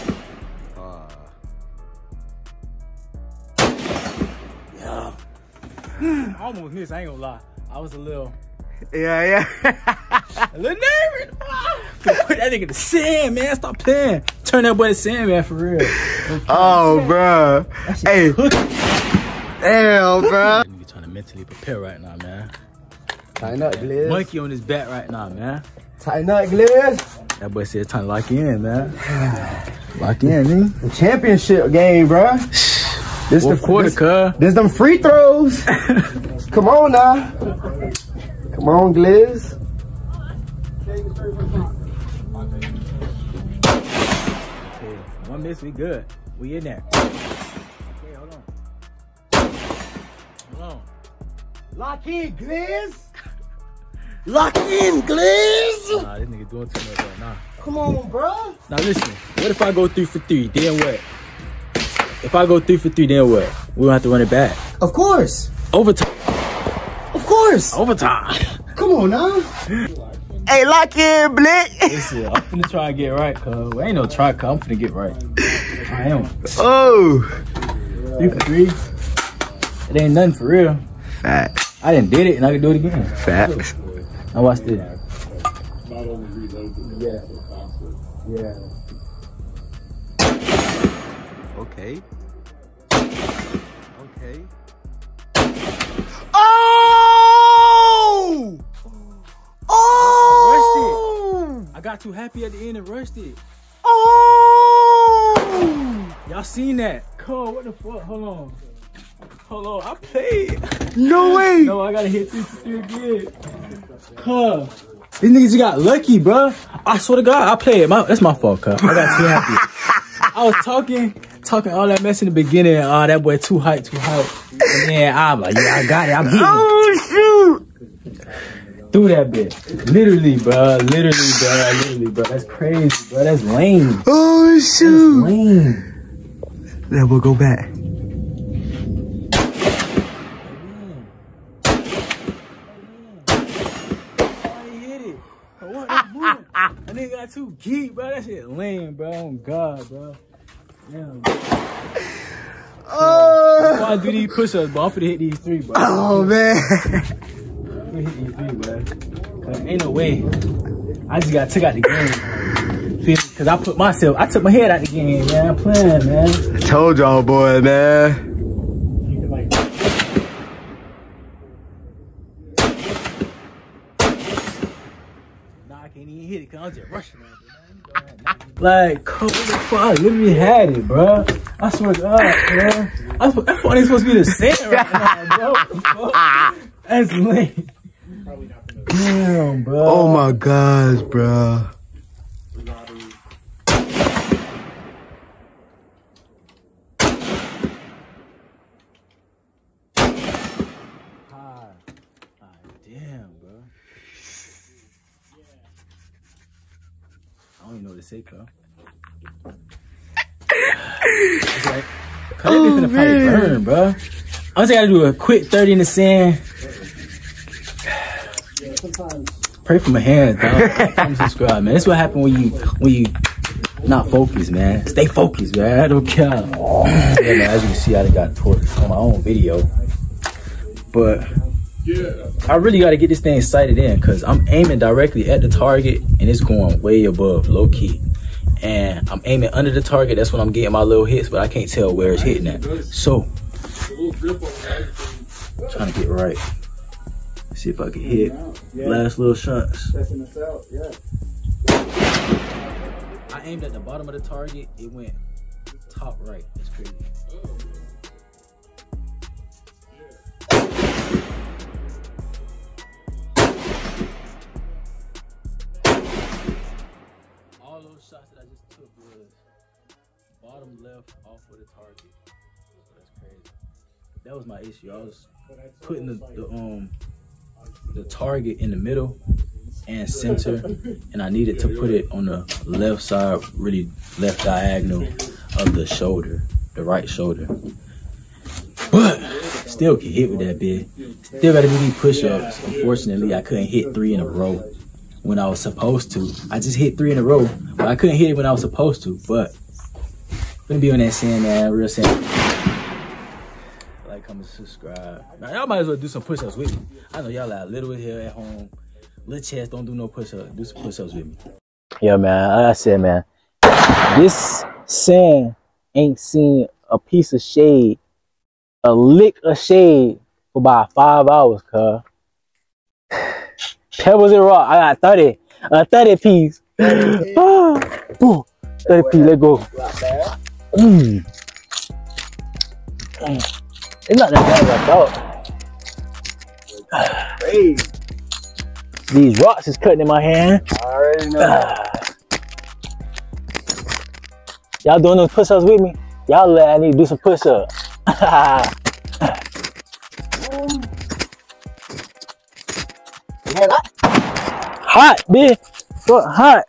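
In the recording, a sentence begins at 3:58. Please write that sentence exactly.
And I'm aiming under the target.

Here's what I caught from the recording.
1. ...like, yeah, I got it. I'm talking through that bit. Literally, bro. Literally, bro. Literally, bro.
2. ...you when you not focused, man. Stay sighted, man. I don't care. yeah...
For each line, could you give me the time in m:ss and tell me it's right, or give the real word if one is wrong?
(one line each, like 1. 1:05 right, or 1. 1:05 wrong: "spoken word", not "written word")
1. 2:05 wrong: "beating", not "talking"
2. 3:42 wrong: "focused", not "sighted".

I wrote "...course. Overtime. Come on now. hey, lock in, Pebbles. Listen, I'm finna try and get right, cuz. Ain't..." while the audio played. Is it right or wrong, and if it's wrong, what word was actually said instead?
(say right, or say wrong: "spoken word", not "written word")
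wrong: "Blick", not "Pebbles".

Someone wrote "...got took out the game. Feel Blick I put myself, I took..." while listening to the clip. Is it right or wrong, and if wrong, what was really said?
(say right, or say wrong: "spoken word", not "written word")
wrong: "Cause", not "Blick".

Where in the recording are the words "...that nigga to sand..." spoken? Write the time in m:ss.
0:12.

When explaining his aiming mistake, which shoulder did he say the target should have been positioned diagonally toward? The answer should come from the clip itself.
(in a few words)
right shoulder.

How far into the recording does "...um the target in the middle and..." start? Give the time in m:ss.
4:36.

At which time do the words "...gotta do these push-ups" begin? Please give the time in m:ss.
4:51.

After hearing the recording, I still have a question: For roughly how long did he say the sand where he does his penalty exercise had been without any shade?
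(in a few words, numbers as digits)
5 hours.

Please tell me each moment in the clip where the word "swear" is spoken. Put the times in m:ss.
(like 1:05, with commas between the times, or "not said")
1:56, 3:01.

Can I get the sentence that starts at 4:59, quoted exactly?
But gonna be on that sand, man, real sand and subscribe.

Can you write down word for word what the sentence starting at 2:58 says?
Like, come the fuck, literally had it, bro.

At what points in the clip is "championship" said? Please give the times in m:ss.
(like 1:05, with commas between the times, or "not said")
0:30.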